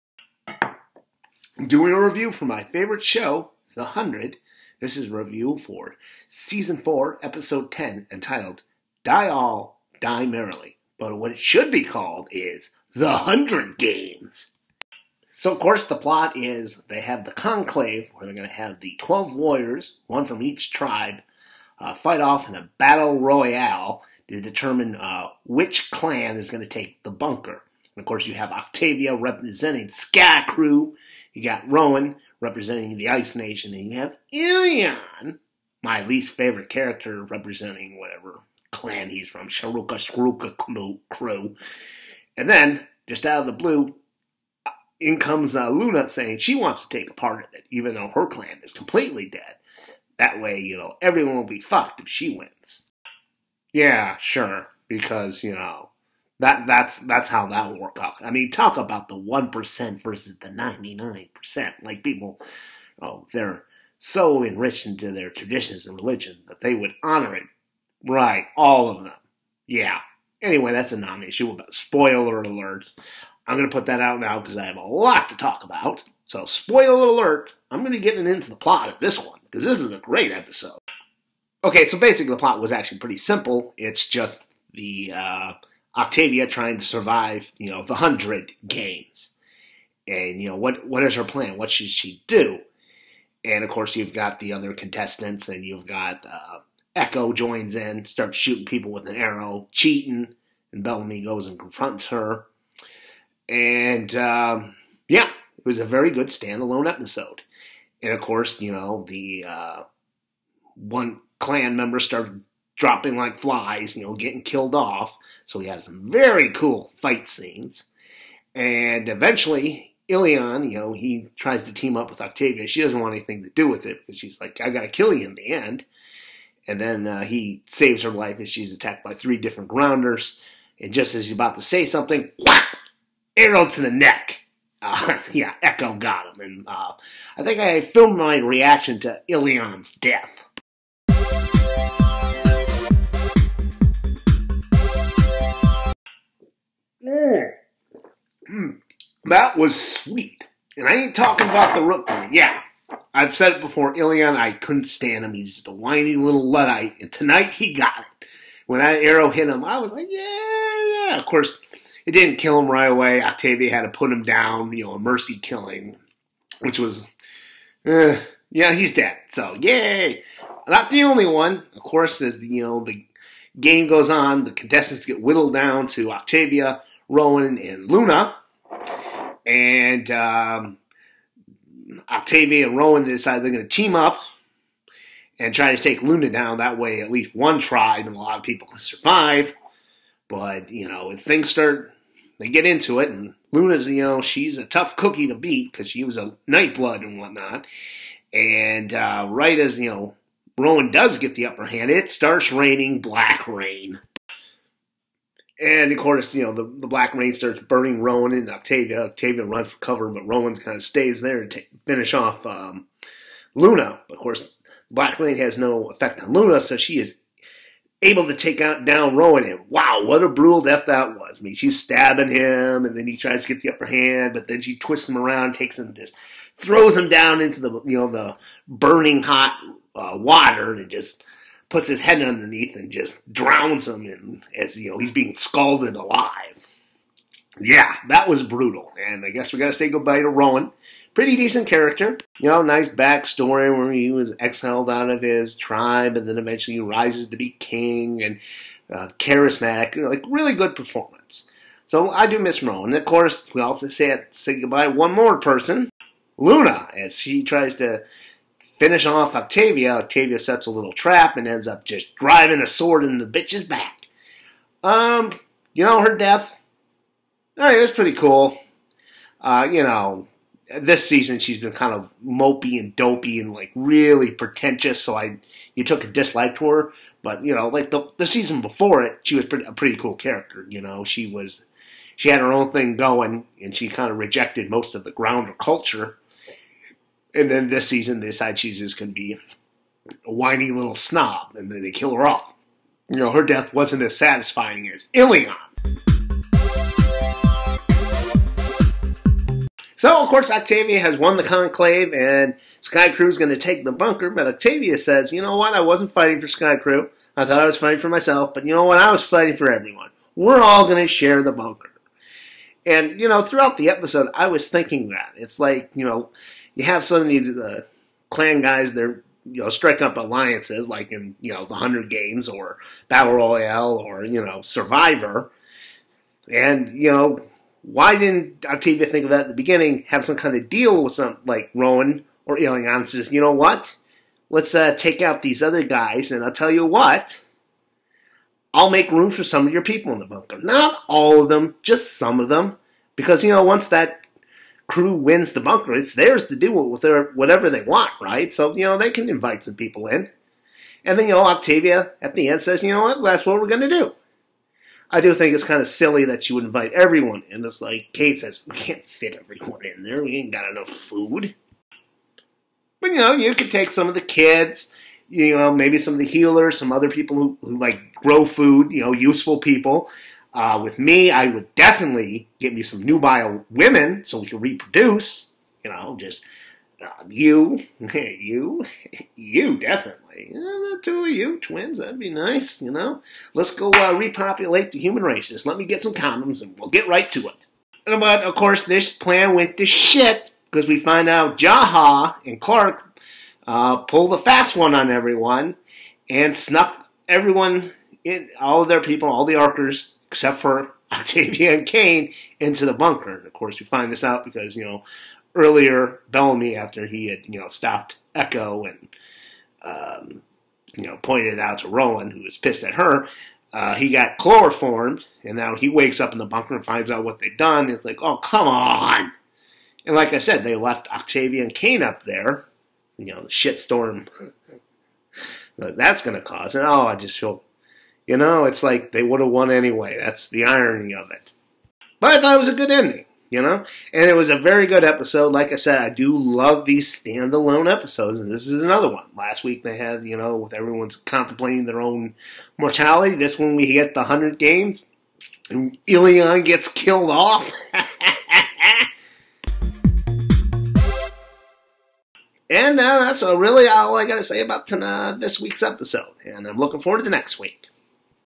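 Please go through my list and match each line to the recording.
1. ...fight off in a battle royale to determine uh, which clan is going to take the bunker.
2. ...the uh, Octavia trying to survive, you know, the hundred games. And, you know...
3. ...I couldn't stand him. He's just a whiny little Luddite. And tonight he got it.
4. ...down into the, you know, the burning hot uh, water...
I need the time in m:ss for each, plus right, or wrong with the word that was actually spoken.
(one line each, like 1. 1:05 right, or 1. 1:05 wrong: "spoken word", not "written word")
1. 0:21 right
2. 1:24 right
3. 2:34 right
4. 3:47 right.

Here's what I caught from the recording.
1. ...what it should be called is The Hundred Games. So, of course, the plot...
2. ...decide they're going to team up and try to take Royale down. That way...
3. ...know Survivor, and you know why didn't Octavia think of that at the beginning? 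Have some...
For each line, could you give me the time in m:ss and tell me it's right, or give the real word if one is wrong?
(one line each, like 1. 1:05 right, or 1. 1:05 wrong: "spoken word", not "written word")
1. 0:11 right
2. 3:03 wrong: "Luna", not "Royale"
3. 5:24 right.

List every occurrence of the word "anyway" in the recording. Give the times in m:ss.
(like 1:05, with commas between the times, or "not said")
1:10, 7:09.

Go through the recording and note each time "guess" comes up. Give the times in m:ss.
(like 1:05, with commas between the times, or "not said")
3:59.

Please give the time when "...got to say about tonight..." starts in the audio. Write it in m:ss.
7:34.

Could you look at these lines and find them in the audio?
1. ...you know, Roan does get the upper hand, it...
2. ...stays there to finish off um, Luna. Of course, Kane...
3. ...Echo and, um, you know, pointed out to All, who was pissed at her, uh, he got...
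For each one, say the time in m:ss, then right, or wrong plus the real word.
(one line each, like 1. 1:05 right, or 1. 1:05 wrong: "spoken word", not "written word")
1. 3:19 right
2. 3:30 wrong: "Black", not "Kane"
3. 6:48 wrong: "Roan", not "All".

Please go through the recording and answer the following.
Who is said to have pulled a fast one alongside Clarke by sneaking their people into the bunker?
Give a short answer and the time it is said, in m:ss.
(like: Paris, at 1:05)
Jaha, at 6:31.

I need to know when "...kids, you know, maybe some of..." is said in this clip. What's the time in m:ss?
6:04.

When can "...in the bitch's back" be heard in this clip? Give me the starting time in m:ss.
4:23.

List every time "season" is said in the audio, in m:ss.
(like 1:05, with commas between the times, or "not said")
0:06, 4:31, 4:38, 4:47.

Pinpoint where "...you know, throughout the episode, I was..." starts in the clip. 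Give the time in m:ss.
5:13.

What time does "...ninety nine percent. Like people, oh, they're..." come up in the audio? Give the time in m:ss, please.
1:00.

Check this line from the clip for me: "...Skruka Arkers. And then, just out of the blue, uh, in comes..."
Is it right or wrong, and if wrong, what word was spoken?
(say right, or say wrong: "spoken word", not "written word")
wrong: "Crew", not "Arkers".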